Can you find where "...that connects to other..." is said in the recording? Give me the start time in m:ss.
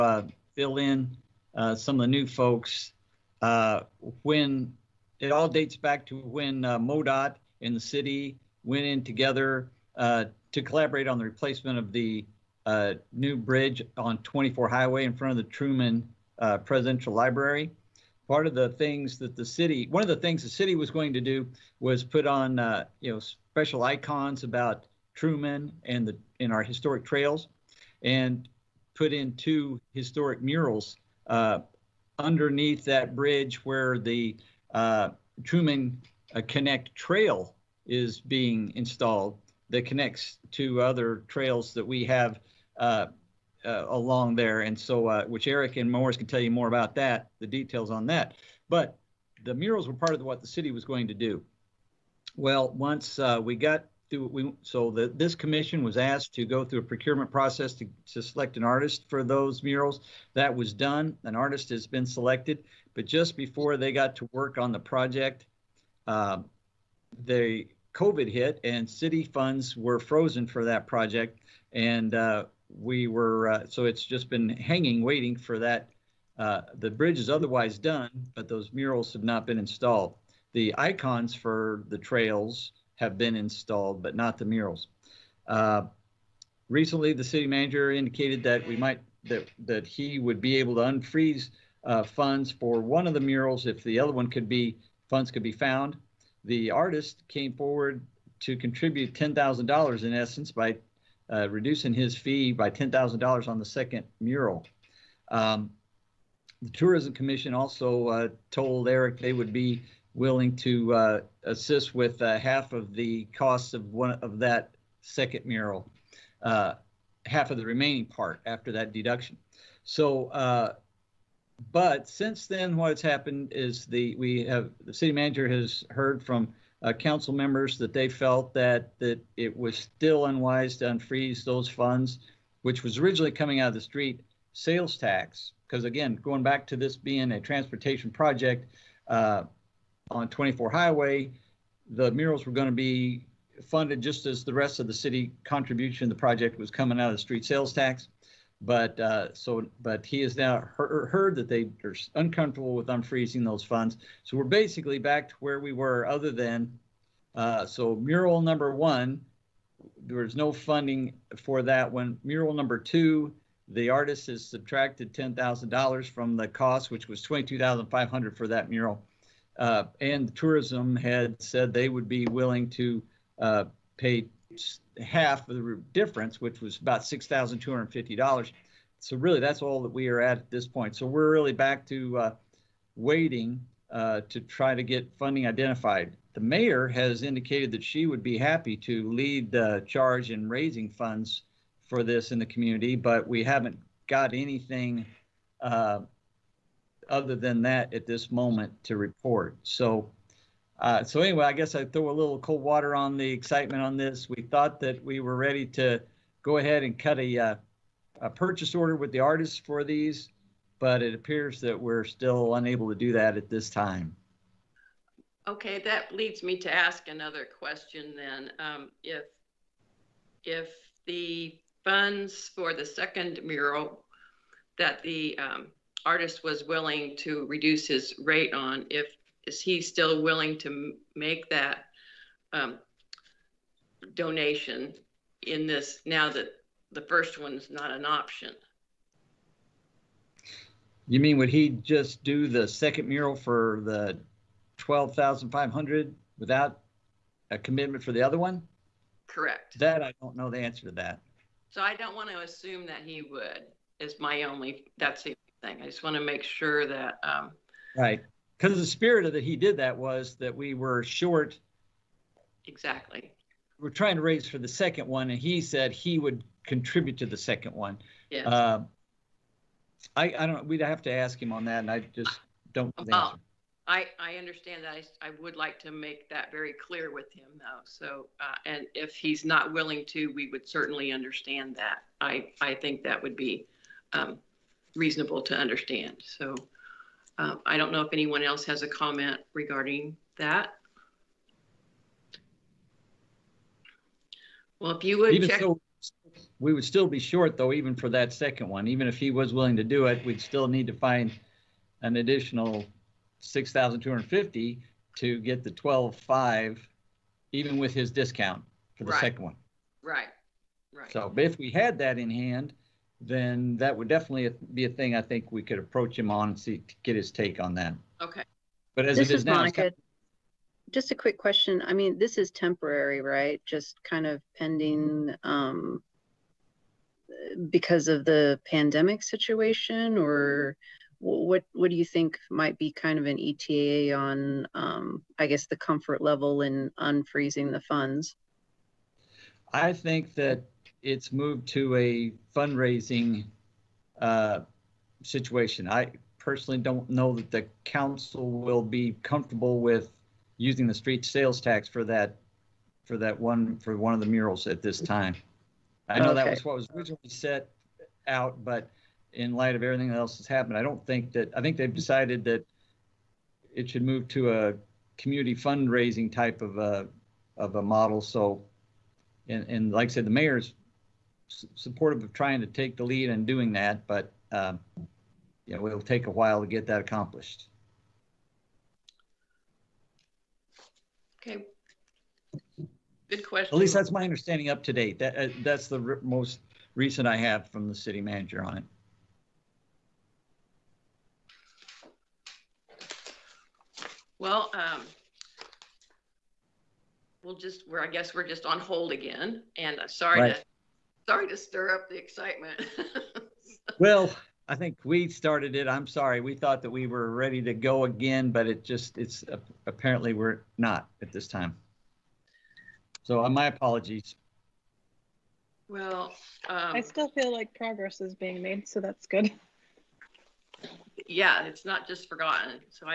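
0:39.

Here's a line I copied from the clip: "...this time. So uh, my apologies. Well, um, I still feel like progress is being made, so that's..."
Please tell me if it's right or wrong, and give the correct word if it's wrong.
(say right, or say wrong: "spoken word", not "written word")
right.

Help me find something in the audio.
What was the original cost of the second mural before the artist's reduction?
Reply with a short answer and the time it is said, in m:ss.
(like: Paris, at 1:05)
$22,500, at 2:47.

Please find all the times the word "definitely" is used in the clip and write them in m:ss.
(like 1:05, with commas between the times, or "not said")
5:14.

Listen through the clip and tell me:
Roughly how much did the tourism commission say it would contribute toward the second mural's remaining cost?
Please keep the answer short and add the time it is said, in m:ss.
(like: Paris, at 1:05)
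$6,250, at 2:57.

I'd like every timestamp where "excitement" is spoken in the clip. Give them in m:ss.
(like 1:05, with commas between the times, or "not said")
3:23, 6:42.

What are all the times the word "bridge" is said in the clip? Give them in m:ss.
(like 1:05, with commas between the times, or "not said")
0:13, 0:33, 1:16.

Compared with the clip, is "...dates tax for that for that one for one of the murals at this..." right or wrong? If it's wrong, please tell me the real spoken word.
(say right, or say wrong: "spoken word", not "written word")
wrong: "sales", not "dates".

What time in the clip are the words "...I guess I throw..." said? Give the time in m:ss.
3:21.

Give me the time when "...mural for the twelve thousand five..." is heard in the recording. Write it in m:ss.
4:03.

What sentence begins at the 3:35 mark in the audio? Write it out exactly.
Okay, that leads me to ask another question then.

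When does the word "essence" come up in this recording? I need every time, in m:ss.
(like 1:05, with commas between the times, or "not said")
1:40.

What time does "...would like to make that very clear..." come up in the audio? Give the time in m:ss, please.
4:35.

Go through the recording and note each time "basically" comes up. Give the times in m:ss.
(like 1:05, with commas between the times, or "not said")
2:34.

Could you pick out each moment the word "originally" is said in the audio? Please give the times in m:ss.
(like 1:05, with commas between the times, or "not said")
2:12, 5:56.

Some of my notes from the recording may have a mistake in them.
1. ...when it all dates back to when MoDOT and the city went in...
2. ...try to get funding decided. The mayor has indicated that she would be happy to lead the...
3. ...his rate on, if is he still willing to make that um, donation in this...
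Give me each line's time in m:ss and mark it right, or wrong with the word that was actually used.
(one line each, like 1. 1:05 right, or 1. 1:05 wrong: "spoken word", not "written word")
1. 0:04 right
2. 3:04 wrong: "identified", not "decided"
3. 3:47 right.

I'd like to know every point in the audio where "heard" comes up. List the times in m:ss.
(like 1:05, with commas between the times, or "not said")
2:05, 2:30.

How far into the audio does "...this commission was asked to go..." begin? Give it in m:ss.
0:55.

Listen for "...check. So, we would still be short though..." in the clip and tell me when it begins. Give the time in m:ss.
4:55.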